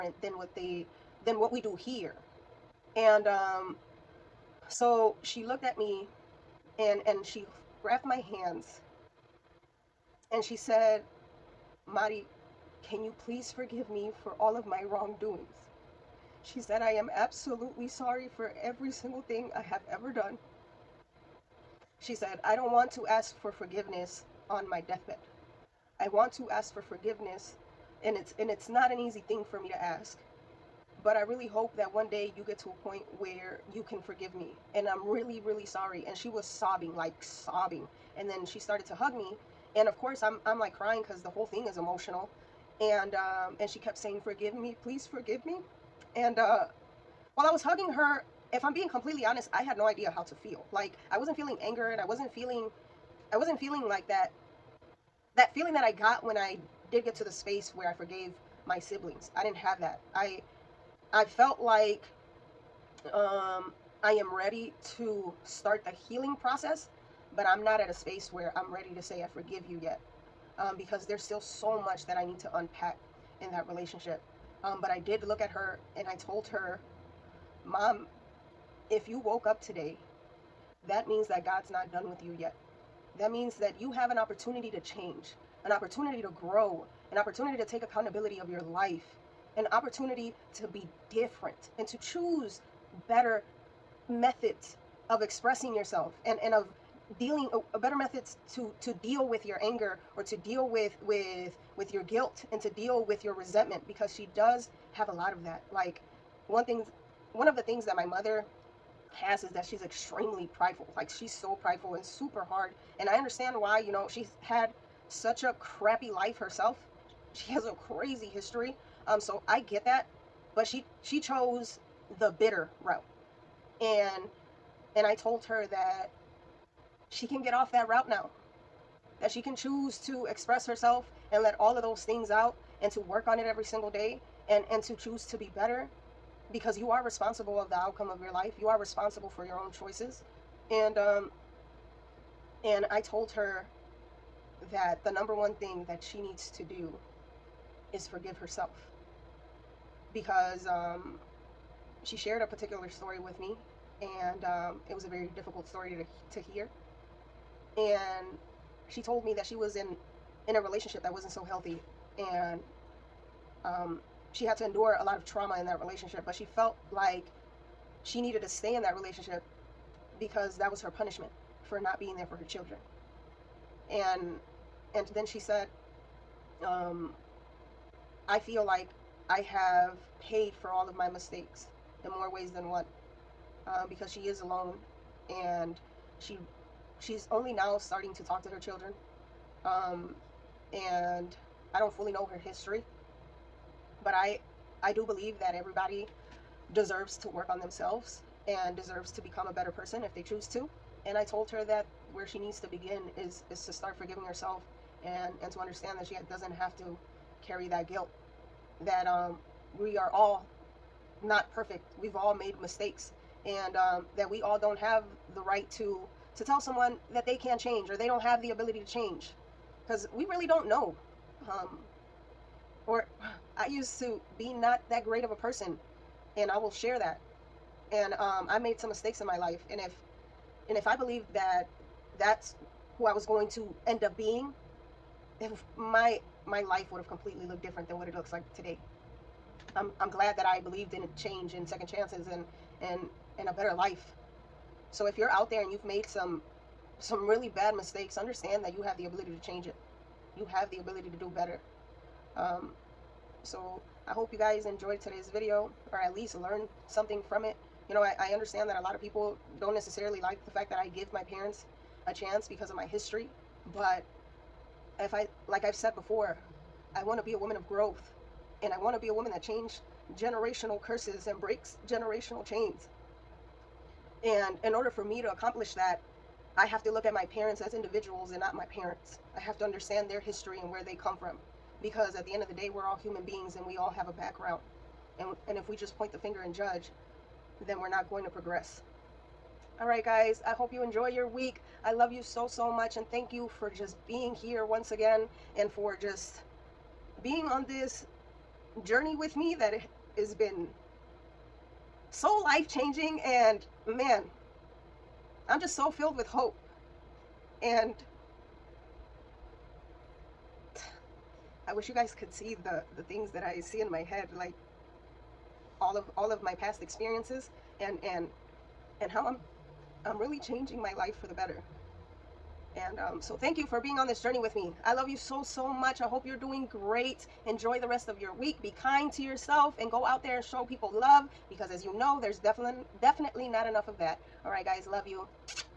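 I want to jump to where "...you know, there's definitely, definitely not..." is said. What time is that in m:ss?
5:31.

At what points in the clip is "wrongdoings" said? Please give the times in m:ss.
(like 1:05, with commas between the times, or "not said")
0:14.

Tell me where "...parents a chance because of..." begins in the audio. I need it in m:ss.
4:21.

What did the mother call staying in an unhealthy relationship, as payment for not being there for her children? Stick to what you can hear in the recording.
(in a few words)
Her punishment.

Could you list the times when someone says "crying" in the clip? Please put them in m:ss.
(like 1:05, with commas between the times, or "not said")
0:40.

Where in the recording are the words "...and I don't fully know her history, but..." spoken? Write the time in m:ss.
3:10.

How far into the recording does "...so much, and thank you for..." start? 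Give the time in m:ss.
4:52.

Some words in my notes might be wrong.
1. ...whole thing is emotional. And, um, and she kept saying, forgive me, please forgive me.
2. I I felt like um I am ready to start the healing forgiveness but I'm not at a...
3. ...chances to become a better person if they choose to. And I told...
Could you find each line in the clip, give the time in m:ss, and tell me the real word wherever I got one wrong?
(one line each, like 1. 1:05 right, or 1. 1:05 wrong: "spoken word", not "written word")
1. 0:41 right
2. 1:00 wrong: "process", not "forgiveness"
3. 3:18 wrong: "deserves", not "chances".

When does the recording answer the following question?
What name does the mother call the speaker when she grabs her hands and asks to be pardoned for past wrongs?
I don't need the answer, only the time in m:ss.
0:11.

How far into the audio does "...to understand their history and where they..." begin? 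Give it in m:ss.
4:39.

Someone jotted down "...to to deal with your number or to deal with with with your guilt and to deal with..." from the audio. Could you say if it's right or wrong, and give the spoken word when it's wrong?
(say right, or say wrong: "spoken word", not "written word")
wrong: "anger", not "number".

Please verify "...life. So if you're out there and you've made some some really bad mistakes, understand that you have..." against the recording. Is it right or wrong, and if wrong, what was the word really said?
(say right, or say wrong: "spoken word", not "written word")
right.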